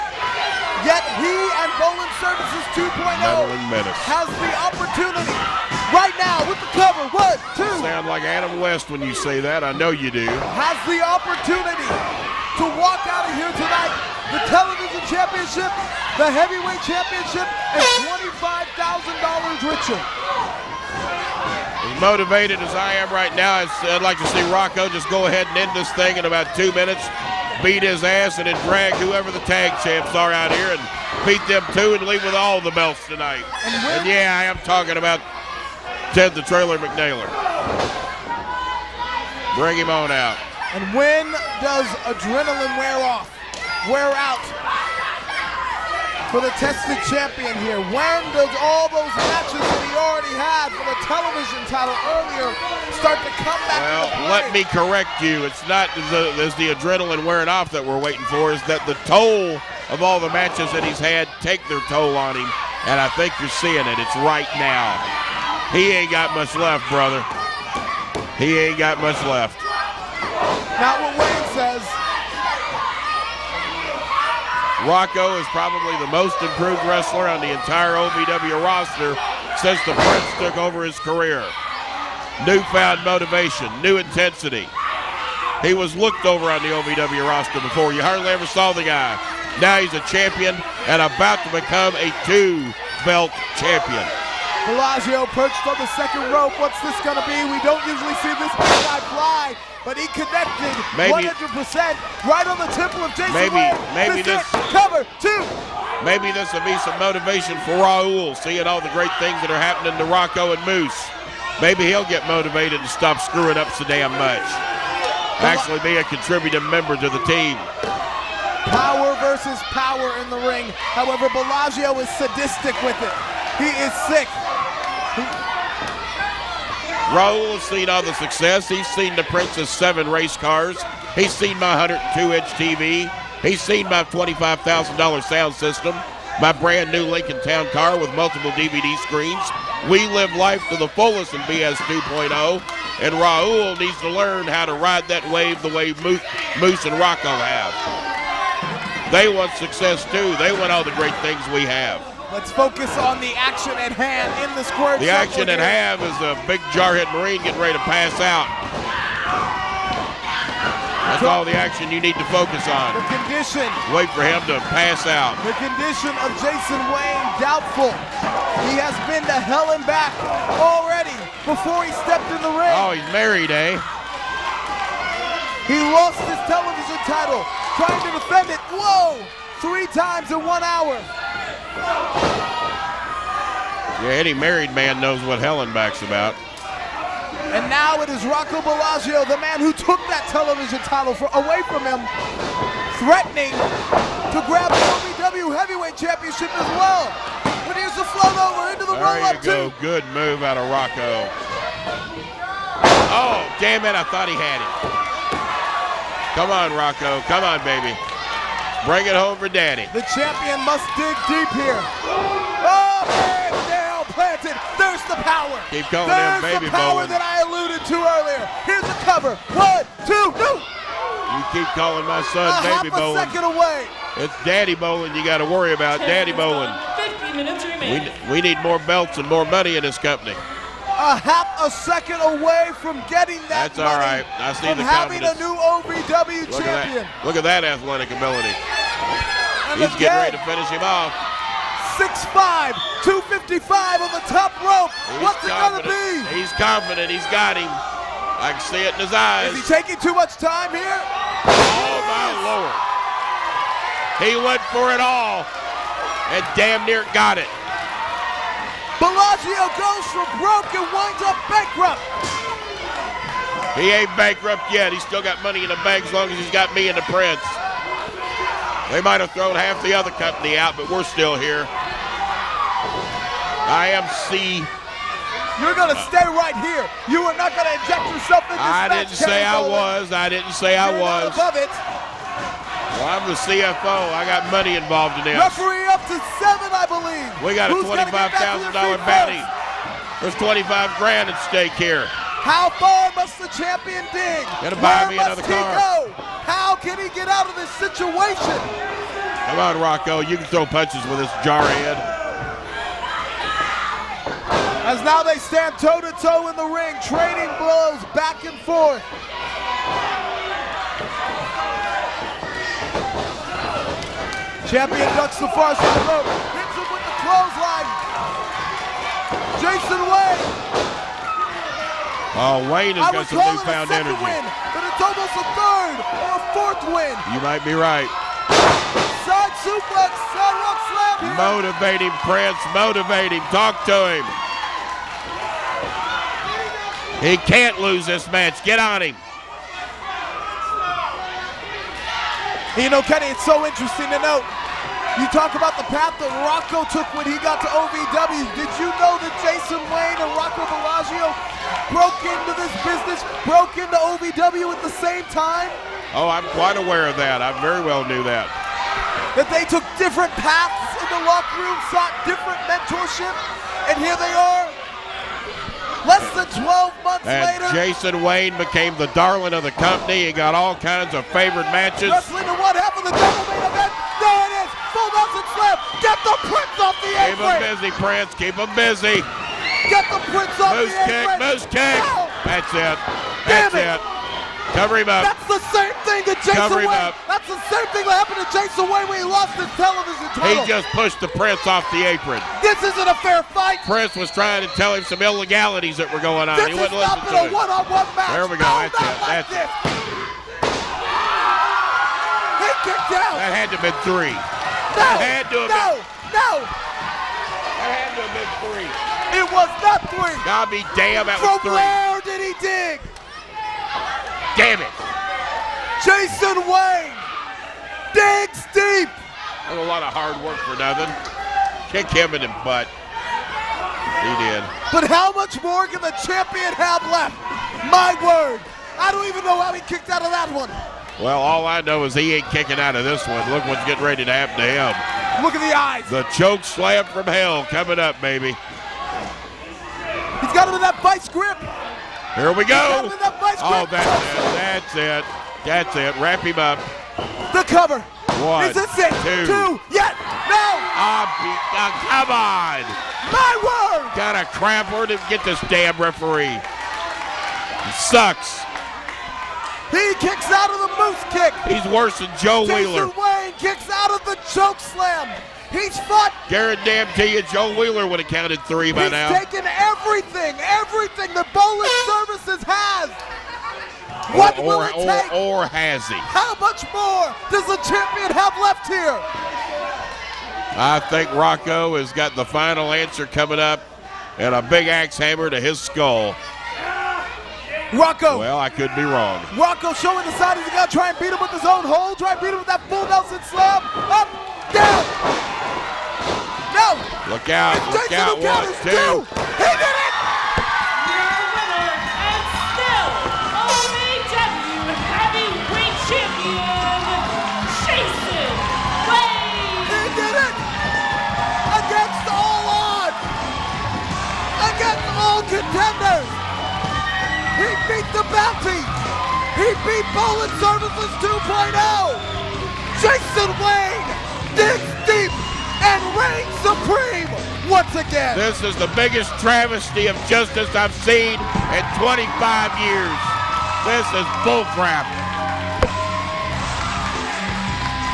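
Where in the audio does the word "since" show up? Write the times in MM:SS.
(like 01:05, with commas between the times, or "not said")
01:19.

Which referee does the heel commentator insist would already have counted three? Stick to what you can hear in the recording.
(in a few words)
Joe Wheeler.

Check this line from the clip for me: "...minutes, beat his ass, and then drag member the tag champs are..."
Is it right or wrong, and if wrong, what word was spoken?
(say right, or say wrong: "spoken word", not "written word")
wrong: "whoever", not "member".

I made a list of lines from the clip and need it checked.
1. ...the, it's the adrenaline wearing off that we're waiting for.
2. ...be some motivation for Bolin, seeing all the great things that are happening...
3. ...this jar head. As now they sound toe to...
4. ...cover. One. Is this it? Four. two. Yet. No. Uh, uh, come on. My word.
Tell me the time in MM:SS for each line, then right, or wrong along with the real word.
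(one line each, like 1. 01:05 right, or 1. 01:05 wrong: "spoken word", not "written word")
1. 00:56 right
2. 01:46 wrong: "Raul", not "Bolin"
3. 05:01 wrong: "stand", not "sound"
4. 07:27 wrong: "Two", not "Four".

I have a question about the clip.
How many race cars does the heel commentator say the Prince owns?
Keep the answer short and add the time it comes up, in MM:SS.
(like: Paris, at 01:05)
7, at 02:09.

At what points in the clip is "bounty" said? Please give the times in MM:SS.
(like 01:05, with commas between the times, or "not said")
04:49, 08:38.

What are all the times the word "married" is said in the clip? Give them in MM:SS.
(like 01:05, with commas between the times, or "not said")
02:53, 03:04.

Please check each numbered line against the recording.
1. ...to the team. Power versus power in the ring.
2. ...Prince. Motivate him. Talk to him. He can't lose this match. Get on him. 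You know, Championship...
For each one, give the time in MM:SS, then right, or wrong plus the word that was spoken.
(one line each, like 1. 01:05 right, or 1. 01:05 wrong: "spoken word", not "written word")
1. 01:56 right
2. 05:32 wrong: "Kenny", not "Championship".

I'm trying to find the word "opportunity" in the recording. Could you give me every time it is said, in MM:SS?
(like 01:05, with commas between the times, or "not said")
00:04, 00:11.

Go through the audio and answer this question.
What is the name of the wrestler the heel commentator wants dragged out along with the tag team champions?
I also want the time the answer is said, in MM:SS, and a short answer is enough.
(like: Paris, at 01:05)
Ted the Trailer McNaylor, at 00:36.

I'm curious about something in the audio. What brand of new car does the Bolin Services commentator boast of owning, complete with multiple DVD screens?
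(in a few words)
Lincoln Town car.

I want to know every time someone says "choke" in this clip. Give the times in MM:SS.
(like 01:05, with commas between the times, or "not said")
07:16, 07:44.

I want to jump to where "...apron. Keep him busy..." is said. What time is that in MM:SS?
06:17.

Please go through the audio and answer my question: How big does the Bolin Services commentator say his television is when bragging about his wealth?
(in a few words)
102-inch.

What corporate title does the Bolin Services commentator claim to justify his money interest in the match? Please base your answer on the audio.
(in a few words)
CFO.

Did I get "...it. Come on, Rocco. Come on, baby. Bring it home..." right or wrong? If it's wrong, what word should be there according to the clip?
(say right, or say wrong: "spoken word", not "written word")
right.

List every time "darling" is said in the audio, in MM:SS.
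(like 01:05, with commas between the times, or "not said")
06:09.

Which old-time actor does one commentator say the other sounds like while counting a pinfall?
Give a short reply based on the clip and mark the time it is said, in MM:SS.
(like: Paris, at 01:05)
Adam West, at 00:08.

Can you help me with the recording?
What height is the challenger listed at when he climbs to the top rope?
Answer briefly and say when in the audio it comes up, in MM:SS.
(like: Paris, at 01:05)
6'5", at 04:01.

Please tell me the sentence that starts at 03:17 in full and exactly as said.
But here's the float over into the roll-up There you go.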